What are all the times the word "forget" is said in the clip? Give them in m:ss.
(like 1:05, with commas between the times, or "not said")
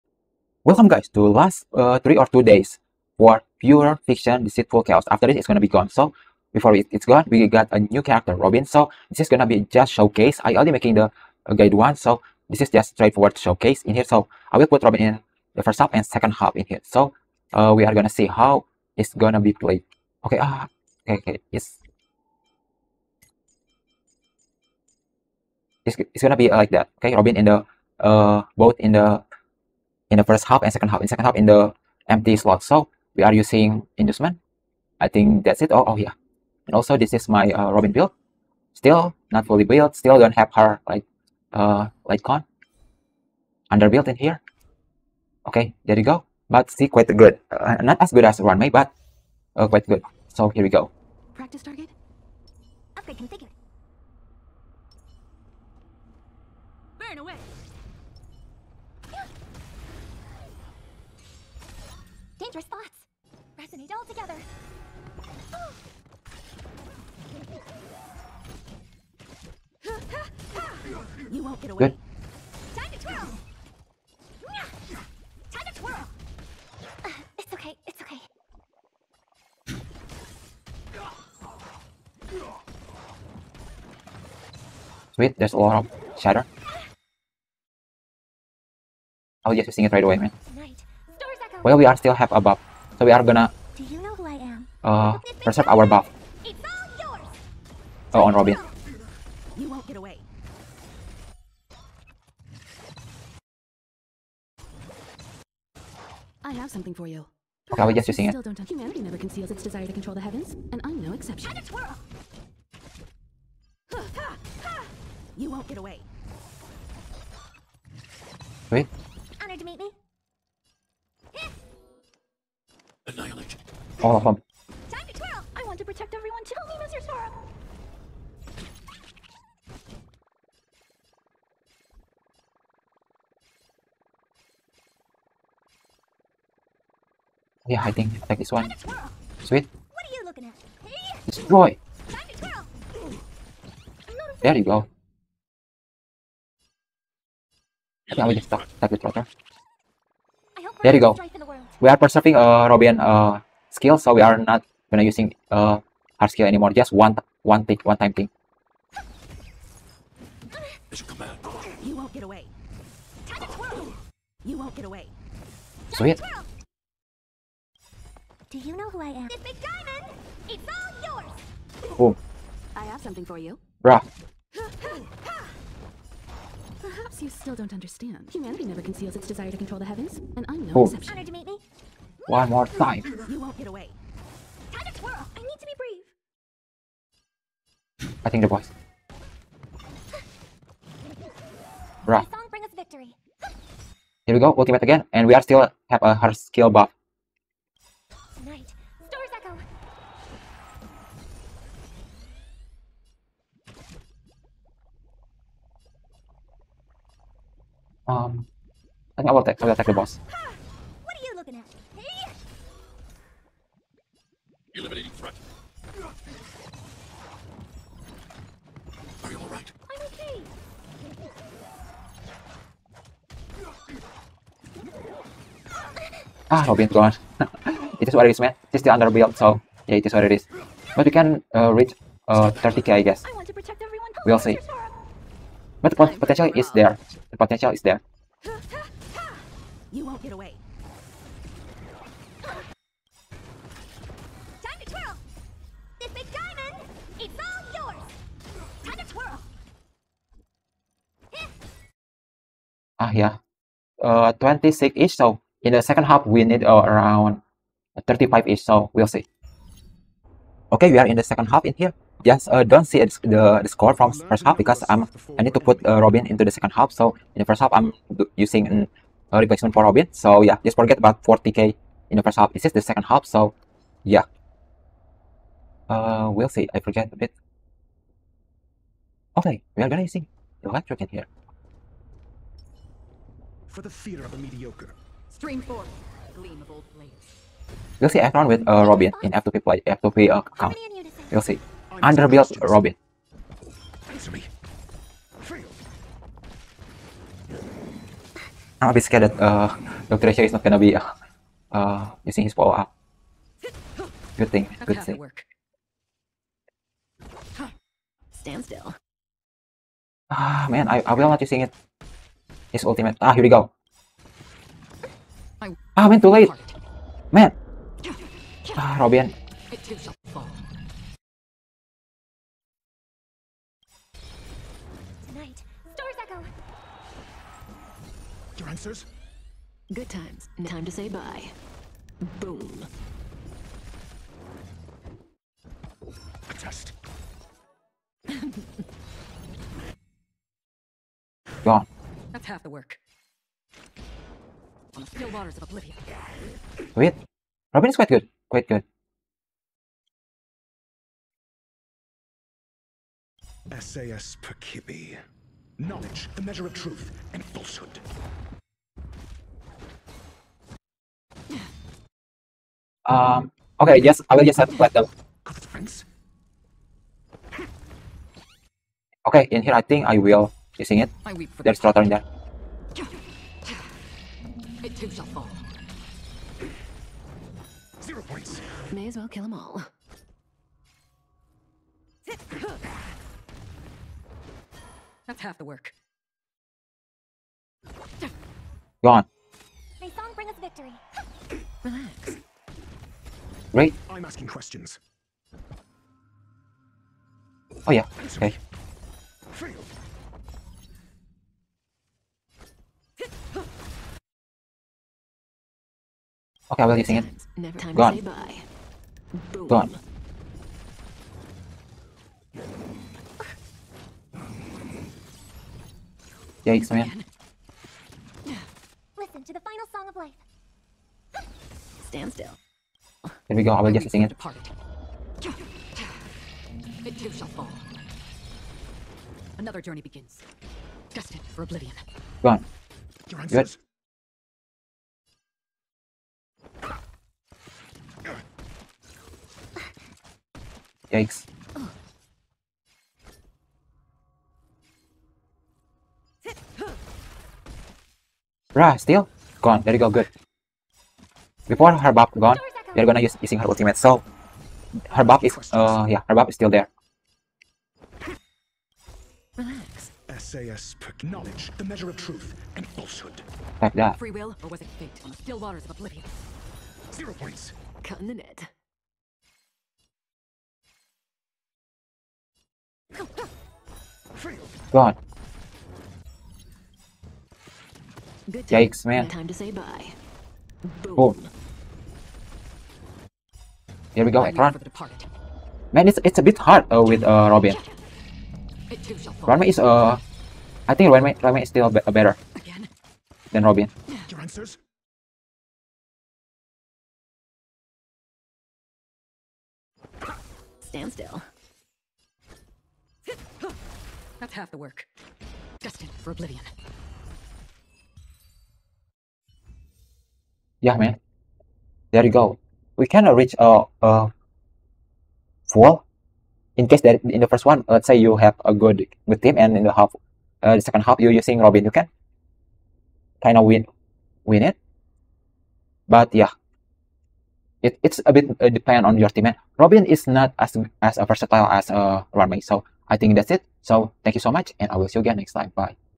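4:30, 4:36.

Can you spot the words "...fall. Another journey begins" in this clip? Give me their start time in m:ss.
7:07.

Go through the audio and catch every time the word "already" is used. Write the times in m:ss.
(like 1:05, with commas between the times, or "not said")
0:10.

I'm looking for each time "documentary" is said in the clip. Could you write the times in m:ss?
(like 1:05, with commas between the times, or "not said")
not said.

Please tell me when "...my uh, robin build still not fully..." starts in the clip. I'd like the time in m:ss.
0:37.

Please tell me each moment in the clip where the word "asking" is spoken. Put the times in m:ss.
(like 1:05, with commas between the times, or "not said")
6:34.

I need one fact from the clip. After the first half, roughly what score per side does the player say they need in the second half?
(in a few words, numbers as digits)
35k.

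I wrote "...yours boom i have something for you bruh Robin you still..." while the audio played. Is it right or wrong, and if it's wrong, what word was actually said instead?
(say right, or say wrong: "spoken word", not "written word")
wrong: "Perhaps", not "Robin".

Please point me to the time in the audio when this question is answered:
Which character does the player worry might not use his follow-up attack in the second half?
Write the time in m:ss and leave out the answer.
5:00.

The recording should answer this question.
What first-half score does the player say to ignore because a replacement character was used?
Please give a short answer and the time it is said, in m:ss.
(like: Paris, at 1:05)
40k, at 4:31.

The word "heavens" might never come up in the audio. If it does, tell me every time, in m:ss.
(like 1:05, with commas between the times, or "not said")
1:50, 2:59.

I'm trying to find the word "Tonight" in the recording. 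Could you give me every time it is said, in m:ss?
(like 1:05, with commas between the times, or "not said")
3:18, 5:25.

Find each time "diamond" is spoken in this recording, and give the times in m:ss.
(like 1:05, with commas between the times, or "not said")
2:49.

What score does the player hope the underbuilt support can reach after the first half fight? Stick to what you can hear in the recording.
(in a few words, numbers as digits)
30k.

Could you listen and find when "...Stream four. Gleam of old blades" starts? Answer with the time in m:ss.
4:45.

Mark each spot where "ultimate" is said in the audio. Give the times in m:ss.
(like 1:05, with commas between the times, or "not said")
3:14, 5:12, 7:33.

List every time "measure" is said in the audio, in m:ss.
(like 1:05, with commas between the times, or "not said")
5:56, 7:41.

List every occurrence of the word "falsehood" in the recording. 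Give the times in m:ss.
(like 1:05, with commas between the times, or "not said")
5:57, 7:42.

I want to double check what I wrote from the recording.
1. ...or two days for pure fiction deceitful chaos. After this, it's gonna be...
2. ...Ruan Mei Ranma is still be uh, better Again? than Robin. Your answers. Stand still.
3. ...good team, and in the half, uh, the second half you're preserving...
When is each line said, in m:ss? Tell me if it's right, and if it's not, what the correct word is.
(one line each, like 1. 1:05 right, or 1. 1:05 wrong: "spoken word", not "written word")
1. 0:02 right
2. 8:11 right
3. 8:39 wrong: "using", not "preserving".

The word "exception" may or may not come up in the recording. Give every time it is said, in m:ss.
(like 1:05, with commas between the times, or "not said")
1:51, 3:00.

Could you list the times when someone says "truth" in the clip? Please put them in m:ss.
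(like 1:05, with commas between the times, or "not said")
5:56, 7:42.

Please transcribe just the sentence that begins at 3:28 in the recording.
Um, I think I will attack.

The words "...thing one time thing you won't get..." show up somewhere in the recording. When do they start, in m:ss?
2:37.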